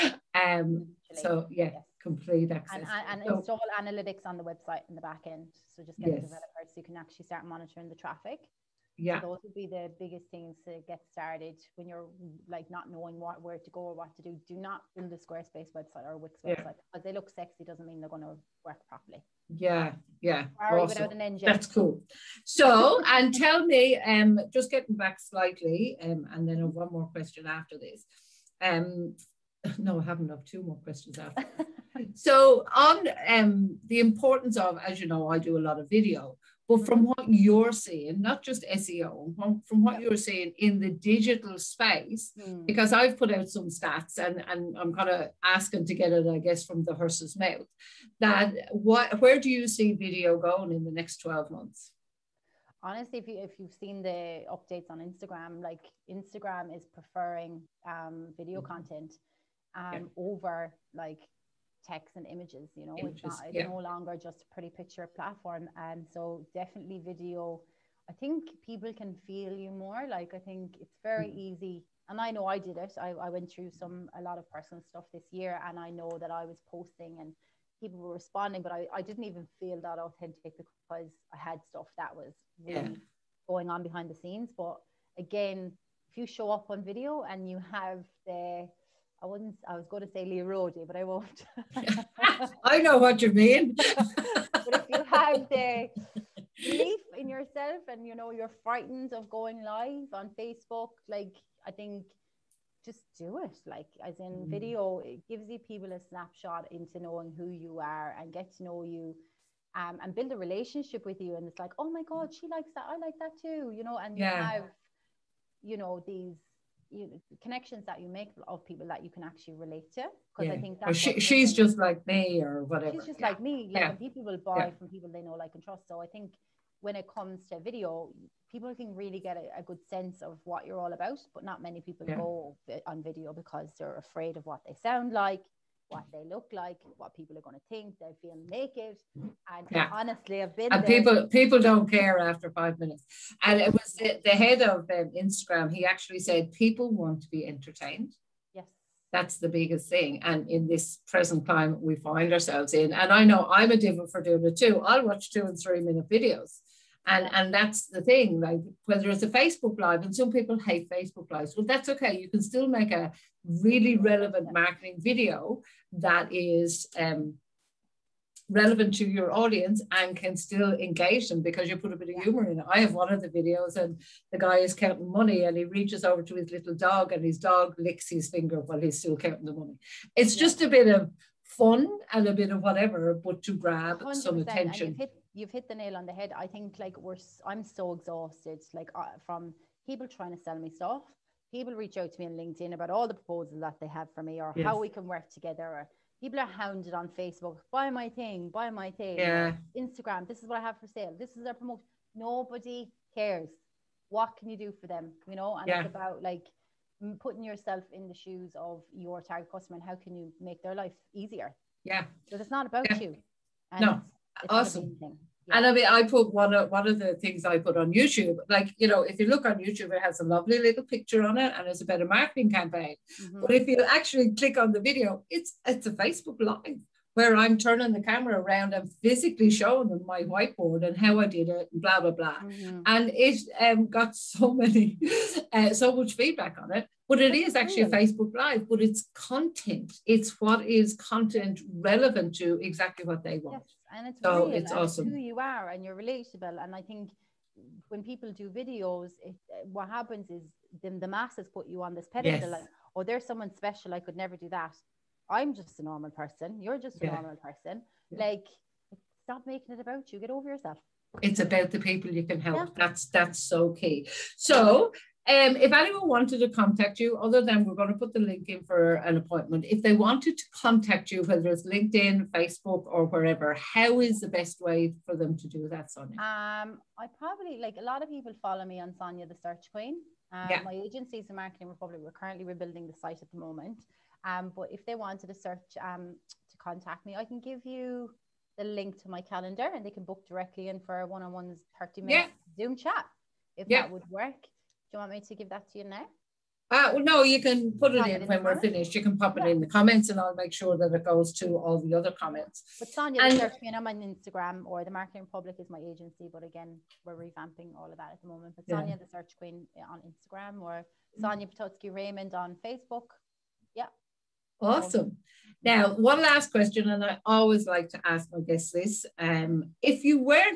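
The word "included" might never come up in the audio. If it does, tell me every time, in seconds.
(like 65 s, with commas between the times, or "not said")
not said.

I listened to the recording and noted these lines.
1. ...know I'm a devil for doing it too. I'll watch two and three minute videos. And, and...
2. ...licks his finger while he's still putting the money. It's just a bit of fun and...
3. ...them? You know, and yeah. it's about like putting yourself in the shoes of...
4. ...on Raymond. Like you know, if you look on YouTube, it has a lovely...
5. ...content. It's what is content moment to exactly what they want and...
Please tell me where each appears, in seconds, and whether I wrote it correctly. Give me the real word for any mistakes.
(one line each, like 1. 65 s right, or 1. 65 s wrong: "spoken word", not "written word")
1. 153 s right
2. 177 s wrong: "counting", not "putting"
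3. 204 s right
4. 217 s wrong: "YouTube", not "Raymond"
5. 239 s wrong: "relevant", not "moment".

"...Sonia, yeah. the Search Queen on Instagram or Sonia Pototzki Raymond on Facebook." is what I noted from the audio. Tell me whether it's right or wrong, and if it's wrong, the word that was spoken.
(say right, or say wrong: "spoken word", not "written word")
right.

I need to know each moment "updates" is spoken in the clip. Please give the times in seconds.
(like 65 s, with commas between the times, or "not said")
54 s.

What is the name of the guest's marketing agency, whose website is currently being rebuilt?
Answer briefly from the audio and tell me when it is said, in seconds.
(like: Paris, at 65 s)
Marketing Republic, at 281 s.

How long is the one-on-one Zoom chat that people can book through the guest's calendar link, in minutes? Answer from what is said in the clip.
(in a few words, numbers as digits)
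30.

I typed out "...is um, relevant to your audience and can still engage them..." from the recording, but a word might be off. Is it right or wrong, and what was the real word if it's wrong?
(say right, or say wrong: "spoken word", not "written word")
right.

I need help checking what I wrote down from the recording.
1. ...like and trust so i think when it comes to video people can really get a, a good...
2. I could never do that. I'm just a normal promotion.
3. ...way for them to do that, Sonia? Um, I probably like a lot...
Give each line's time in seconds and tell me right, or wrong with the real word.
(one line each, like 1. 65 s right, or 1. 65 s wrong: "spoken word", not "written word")
1. 125 s right
2. 253 s wrong: "person", not "promotion"
3. 274 s right.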